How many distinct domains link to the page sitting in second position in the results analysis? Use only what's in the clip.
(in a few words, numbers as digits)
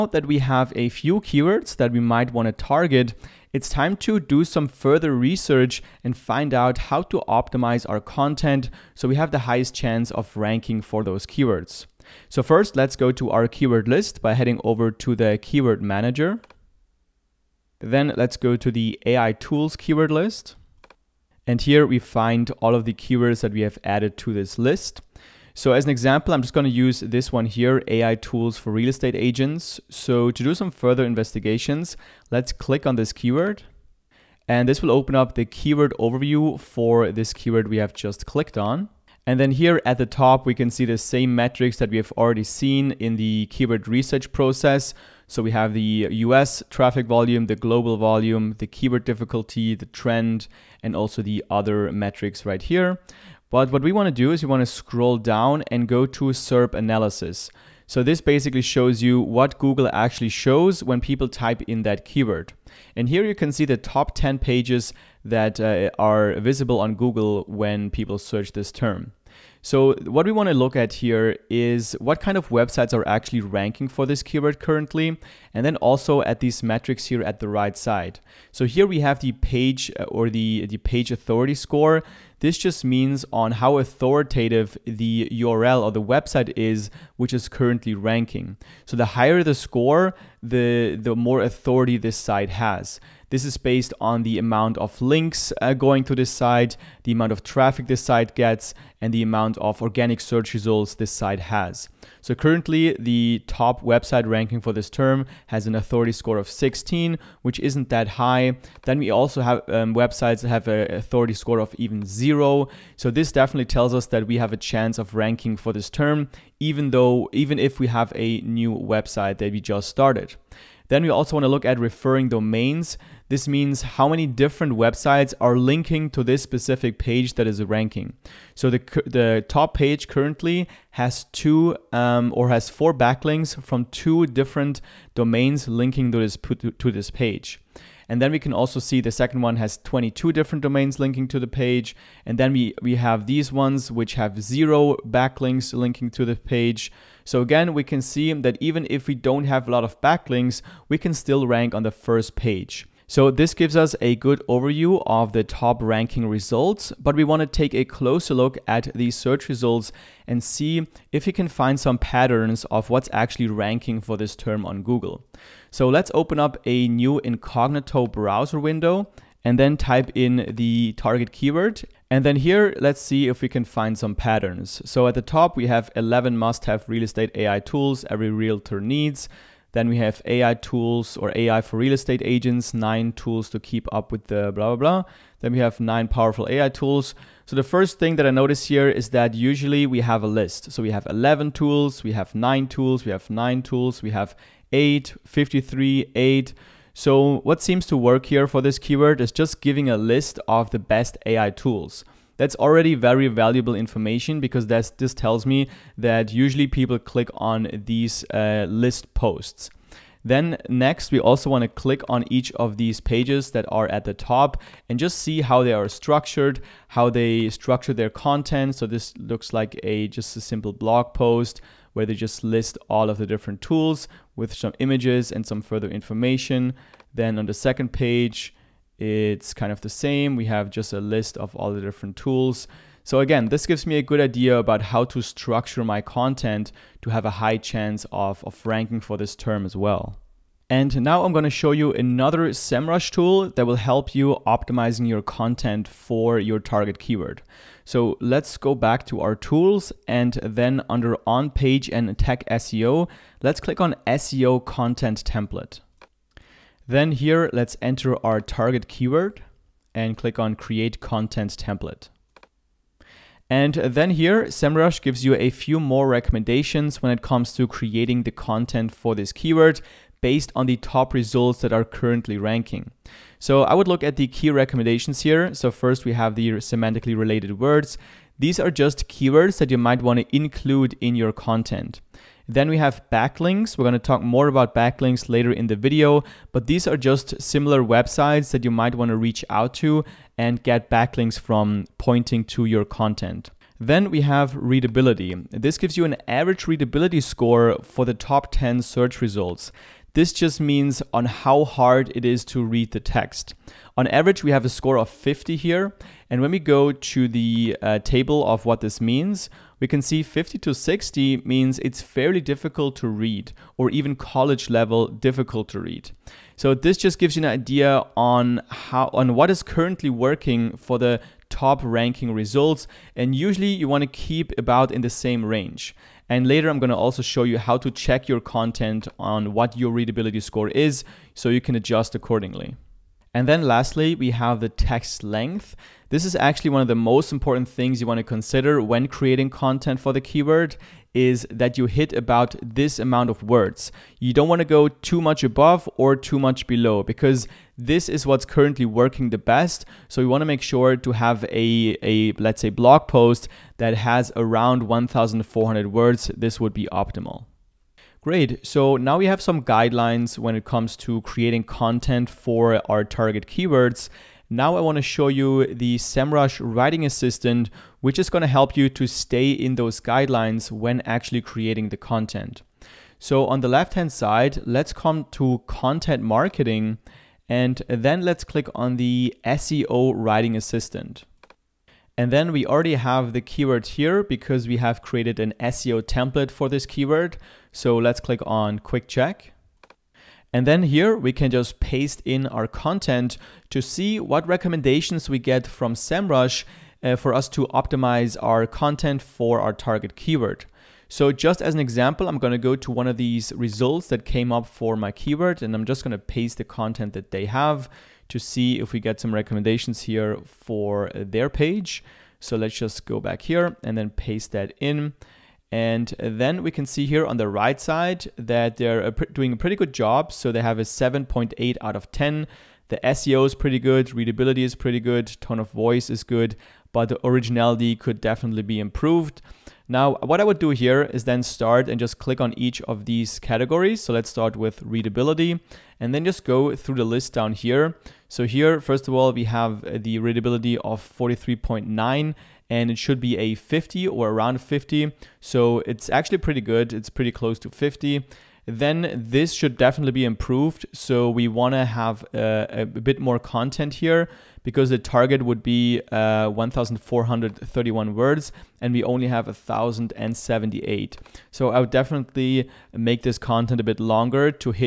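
22.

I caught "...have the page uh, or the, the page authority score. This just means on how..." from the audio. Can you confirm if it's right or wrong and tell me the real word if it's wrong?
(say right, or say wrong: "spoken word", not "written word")
right.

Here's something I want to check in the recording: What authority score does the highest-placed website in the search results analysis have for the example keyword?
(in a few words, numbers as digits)
16.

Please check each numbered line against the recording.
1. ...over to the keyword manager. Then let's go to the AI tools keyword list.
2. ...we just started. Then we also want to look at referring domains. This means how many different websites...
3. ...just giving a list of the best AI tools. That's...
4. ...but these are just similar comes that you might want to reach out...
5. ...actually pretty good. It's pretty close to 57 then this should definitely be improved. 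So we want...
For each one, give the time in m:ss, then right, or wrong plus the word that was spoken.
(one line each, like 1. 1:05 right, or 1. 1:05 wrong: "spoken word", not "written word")
1. 0:14 right
2. 1:59 right
3. 3:19 right
4. 4:46 wrong: "websites", not "comes"
5. 7:26 wrong: "50", not "57".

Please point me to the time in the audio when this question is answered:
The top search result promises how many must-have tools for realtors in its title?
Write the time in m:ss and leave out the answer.
2:55.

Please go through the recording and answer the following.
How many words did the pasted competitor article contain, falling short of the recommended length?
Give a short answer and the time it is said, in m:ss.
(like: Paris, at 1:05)
1,078, at 7:39.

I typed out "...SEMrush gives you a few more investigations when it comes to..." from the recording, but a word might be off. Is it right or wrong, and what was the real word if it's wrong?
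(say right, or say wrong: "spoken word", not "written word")
wrong: "recommendations", not "investigations".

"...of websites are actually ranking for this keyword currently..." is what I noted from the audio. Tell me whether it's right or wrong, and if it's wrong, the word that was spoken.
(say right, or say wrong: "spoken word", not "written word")
right.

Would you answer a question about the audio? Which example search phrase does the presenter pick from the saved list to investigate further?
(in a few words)
AI tools for real estate agents.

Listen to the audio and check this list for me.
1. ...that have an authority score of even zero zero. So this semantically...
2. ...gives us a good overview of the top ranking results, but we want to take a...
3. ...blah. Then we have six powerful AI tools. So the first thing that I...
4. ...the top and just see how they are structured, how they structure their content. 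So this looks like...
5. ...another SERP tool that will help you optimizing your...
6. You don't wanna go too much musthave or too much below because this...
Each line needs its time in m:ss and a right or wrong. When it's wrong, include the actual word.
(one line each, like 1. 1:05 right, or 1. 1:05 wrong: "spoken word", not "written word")
1. 1:50 wrong: "definitely", not "semantically"
2. 2:33 right
3. 3:04 wrong: "nine", not "six"
4. 3:34 right
5. 4:01 wrong: "SEMrush", not "SERP"
6. 5:44 wrong: "above", not "musthave".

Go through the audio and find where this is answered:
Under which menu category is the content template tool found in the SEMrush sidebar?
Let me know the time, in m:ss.
4:11.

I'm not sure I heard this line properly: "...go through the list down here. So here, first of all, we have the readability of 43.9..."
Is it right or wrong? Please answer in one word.
right.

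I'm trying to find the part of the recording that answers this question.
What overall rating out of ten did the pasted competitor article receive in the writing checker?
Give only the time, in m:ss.
7:00.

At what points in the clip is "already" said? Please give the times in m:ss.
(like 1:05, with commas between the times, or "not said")
0:42, 3:22, 6:22.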